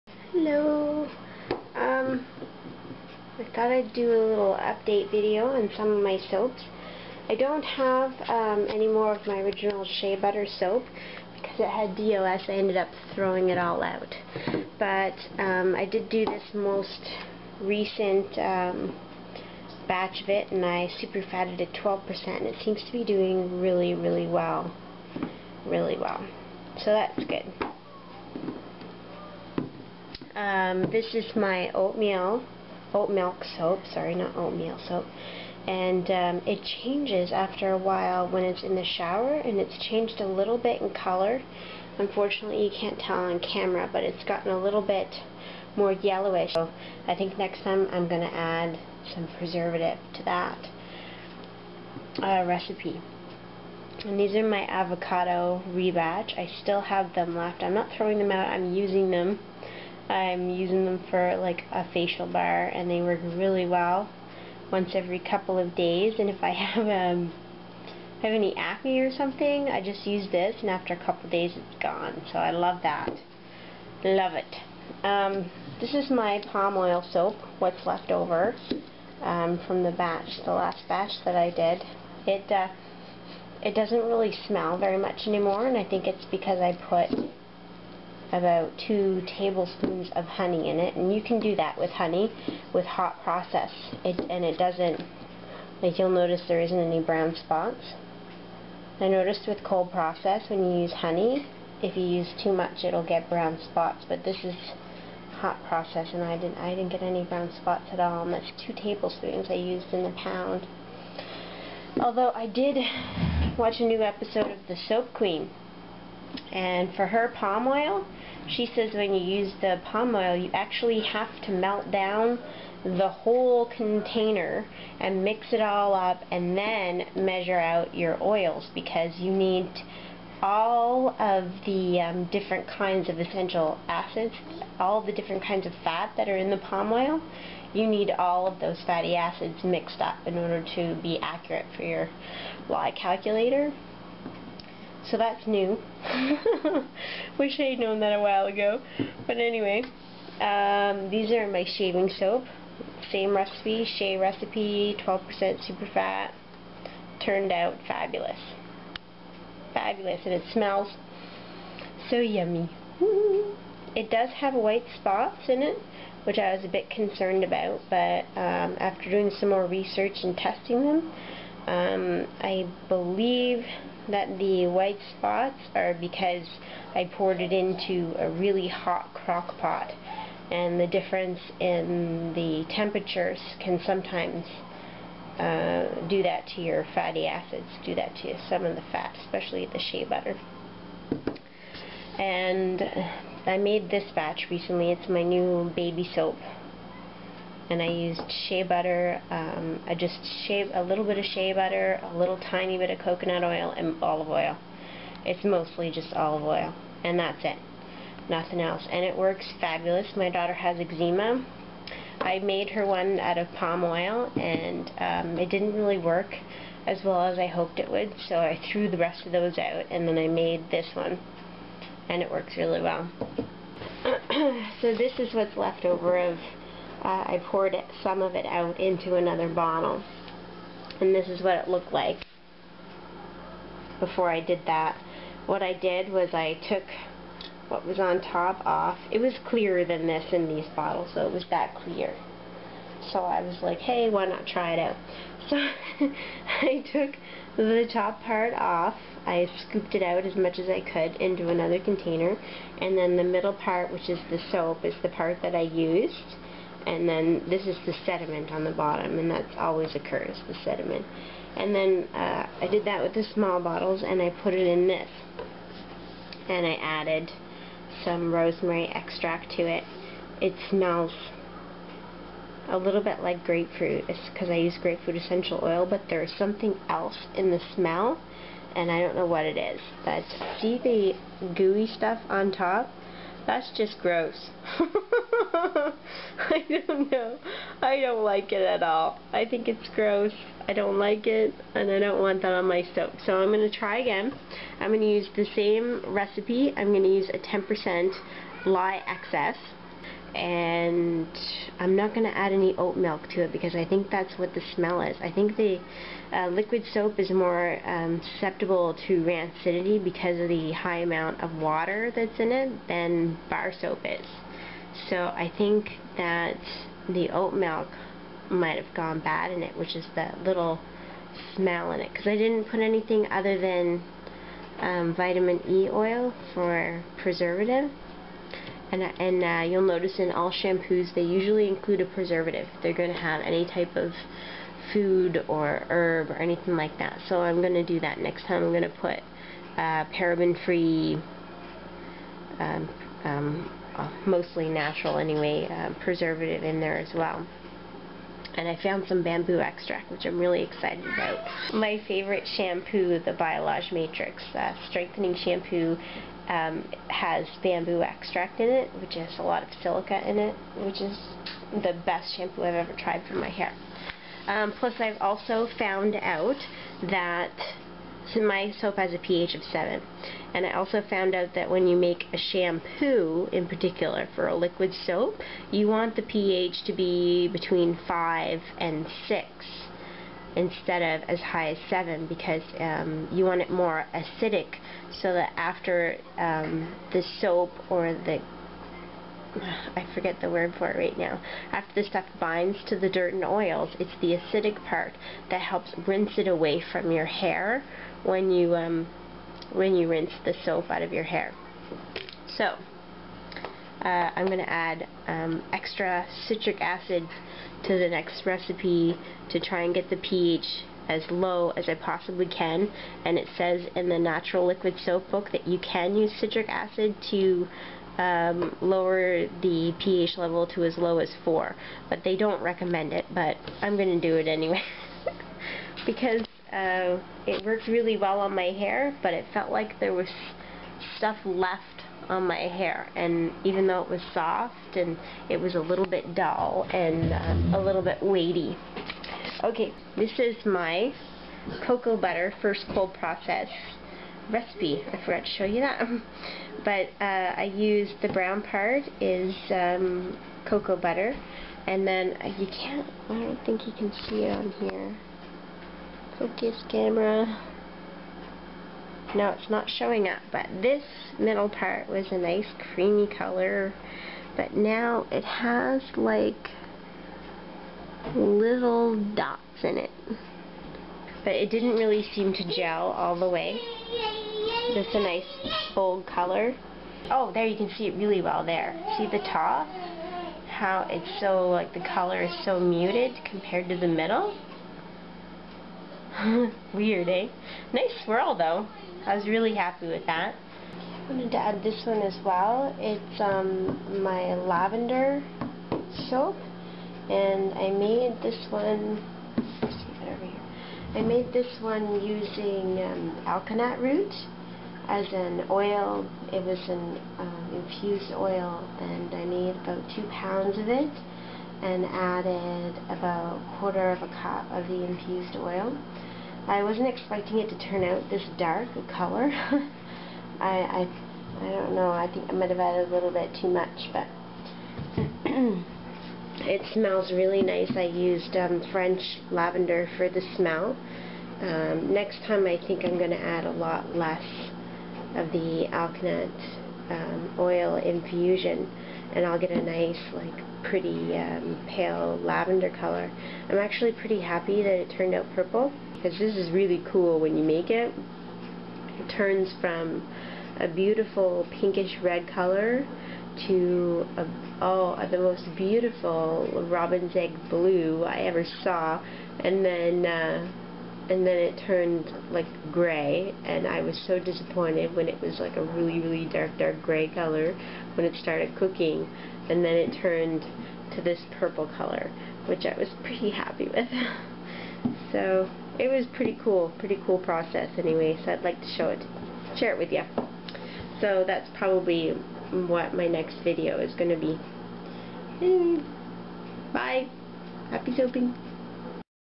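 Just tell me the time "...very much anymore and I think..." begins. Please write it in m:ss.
1:24.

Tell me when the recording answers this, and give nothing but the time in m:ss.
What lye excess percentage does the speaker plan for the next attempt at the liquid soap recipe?
4:57.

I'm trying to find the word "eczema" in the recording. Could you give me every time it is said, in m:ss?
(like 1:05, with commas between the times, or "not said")
3:30.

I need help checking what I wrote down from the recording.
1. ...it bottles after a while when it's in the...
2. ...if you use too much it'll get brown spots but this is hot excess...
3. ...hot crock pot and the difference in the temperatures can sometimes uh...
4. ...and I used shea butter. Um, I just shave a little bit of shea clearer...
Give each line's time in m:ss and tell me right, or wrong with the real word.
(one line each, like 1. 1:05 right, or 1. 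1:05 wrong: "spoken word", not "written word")
1. 0:36 wrong: "changes", not "bottles"
2. 1:41 wrong: "process", not "excess"
3. 2:58 right
4. 3:17 wrong: "butter", not "clearer".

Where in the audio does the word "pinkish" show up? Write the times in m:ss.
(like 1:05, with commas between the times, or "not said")
9:11.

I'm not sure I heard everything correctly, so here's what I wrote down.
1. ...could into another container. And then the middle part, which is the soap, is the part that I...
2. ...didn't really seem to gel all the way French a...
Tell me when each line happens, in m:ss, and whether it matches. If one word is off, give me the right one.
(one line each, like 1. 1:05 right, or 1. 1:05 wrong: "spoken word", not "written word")
1. 4:10 right
2. 7:51 wrong: "Just", not "French".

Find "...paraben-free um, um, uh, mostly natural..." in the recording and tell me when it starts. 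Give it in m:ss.
5:40.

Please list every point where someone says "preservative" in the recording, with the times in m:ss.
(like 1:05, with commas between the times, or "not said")
0:49, 5:27, 5:32, 5:46.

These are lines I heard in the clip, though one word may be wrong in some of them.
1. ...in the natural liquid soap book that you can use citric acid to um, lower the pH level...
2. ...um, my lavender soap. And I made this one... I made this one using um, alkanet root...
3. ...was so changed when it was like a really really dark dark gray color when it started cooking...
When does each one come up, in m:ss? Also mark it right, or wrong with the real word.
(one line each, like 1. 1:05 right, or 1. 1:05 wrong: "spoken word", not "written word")
1. 6:53 right
2. 8:13 right
3. 9:24 wrong: "disappointed", not "changed".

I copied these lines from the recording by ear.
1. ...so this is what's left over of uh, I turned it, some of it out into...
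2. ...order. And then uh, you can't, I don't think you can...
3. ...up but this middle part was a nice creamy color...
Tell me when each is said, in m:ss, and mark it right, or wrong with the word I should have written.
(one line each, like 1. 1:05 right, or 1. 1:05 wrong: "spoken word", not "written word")
1. 3:44 wrong: "poured", not "turned"
2. 7:30 wrong: "butter", not "order"
3. 7:40 right.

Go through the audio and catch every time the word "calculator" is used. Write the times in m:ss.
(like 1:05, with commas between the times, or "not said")
2:22.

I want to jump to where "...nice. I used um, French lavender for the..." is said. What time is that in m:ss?
8:47.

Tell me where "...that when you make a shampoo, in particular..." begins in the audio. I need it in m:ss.
6:11.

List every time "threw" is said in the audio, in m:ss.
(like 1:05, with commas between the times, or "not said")
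3:38.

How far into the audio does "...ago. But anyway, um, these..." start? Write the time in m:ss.
2:28.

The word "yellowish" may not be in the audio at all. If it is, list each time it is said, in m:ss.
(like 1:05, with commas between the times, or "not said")
0:45.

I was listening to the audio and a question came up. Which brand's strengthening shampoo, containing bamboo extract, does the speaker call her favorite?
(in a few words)
Biolage Matrix.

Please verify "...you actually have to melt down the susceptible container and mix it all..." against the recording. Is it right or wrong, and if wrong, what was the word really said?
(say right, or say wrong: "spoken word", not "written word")
wrong: "whole", not "susceptible".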